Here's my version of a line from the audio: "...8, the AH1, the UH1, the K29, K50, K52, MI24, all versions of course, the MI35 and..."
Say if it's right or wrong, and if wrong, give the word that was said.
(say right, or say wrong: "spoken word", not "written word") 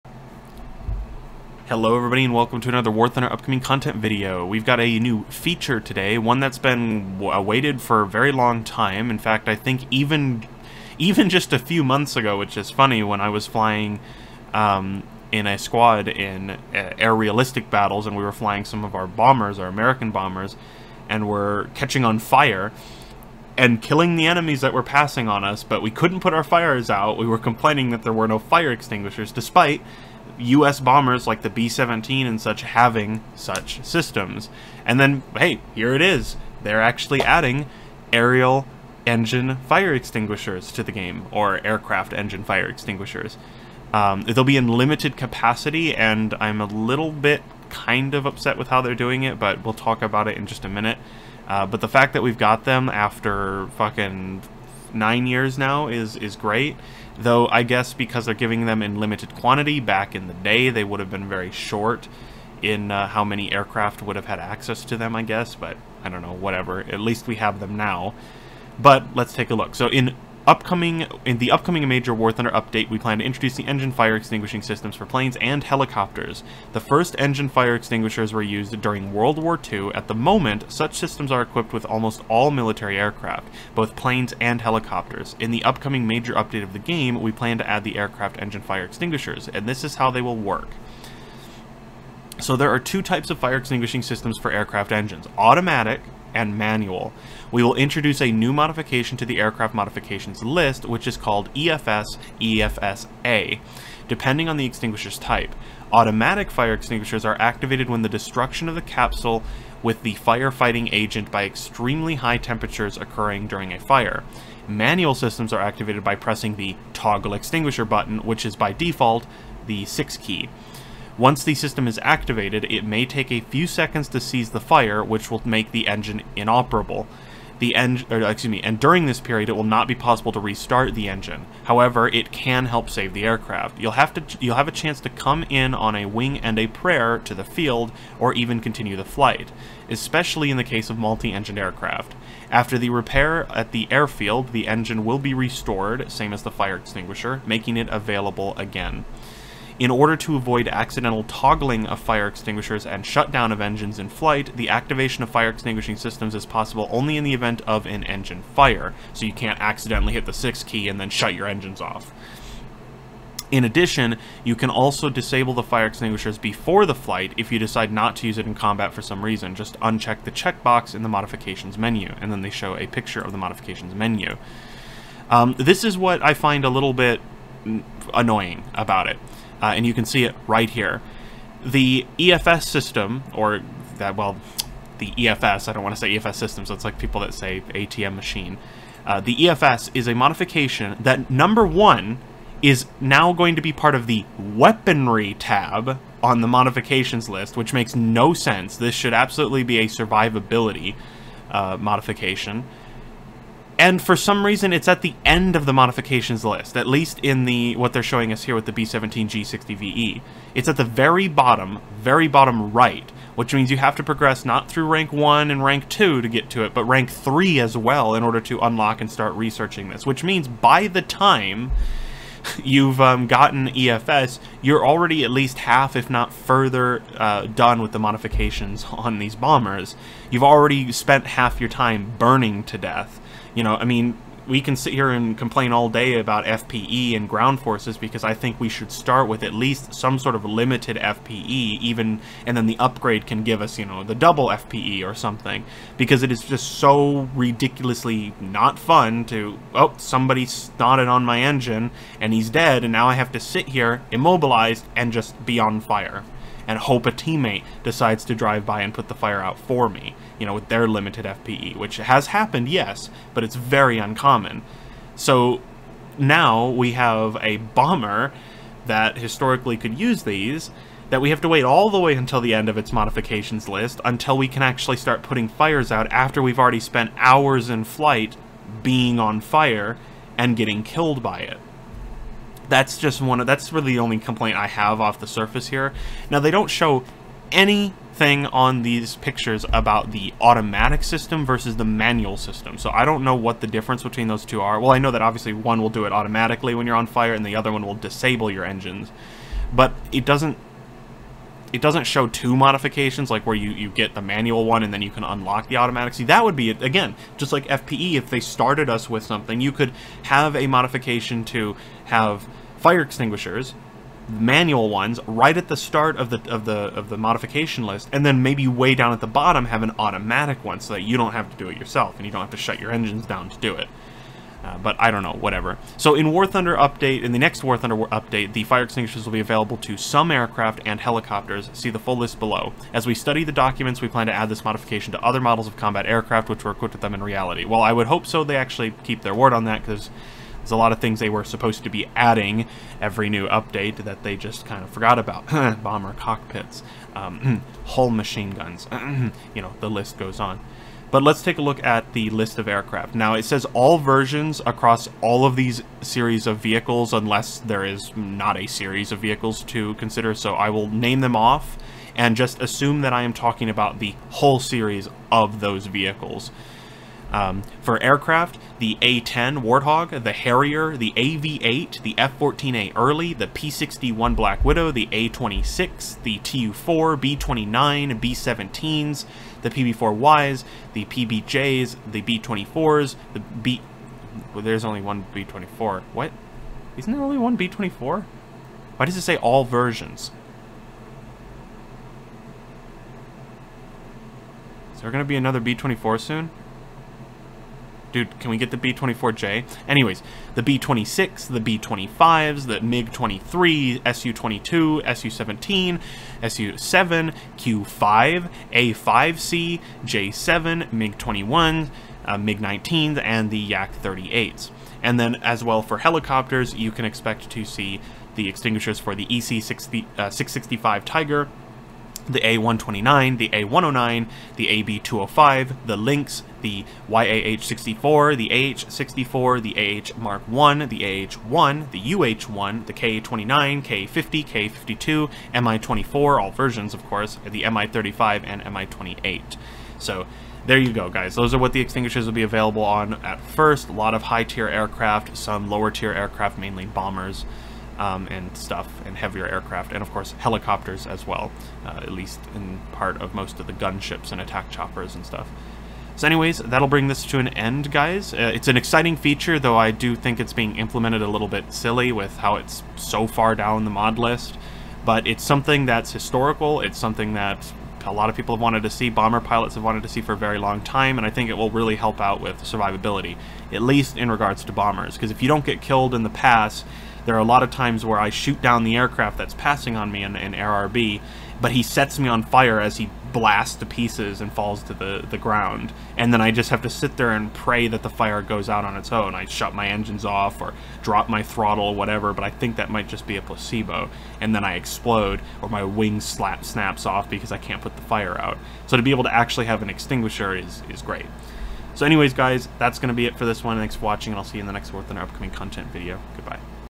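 wrong: "1", not "8".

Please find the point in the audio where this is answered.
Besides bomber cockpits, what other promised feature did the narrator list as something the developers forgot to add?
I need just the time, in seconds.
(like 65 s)
347 s.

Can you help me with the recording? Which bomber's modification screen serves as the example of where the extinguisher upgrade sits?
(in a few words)
B-17G-60-VE.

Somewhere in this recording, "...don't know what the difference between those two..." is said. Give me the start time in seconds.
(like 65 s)
293 s.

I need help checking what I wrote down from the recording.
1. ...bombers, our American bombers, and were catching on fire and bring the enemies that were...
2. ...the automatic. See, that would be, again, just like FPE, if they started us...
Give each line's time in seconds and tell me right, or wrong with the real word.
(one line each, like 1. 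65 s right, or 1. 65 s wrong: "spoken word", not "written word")
1. 19 s wrong: "killing", not "bring"
2. 305 s right.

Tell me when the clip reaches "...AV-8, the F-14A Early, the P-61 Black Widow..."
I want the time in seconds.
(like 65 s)
371 s.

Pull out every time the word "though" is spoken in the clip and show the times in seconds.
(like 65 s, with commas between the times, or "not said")
57 s, 459 s.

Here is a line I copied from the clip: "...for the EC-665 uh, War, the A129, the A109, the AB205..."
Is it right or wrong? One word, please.
wrong.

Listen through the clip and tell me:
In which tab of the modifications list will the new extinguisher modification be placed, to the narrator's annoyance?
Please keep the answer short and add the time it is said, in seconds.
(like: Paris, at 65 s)
weaponry, at 194 s.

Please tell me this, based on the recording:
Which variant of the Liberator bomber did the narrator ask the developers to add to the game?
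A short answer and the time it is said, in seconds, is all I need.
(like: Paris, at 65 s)
B-24J, at 398 s.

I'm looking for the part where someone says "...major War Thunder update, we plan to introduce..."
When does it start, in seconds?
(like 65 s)
71 s.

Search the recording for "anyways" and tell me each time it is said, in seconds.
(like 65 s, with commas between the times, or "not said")
399 s, 456 s, 502 s.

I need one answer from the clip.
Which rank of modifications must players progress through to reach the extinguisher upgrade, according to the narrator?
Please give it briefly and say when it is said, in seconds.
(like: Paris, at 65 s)
rank 3, at 216 s.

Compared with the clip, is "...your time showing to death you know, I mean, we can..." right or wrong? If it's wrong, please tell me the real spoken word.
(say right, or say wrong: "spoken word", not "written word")
wrong: "burning", not "showing".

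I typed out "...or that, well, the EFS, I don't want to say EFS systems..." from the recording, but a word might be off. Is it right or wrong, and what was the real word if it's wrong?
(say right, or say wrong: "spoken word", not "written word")
right.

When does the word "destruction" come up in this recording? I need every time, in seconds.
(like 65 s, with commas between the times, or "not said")
108 s.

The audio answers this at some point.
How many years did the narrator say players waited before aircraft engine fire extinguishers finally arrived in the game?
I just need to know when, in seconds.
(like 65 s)
54 s.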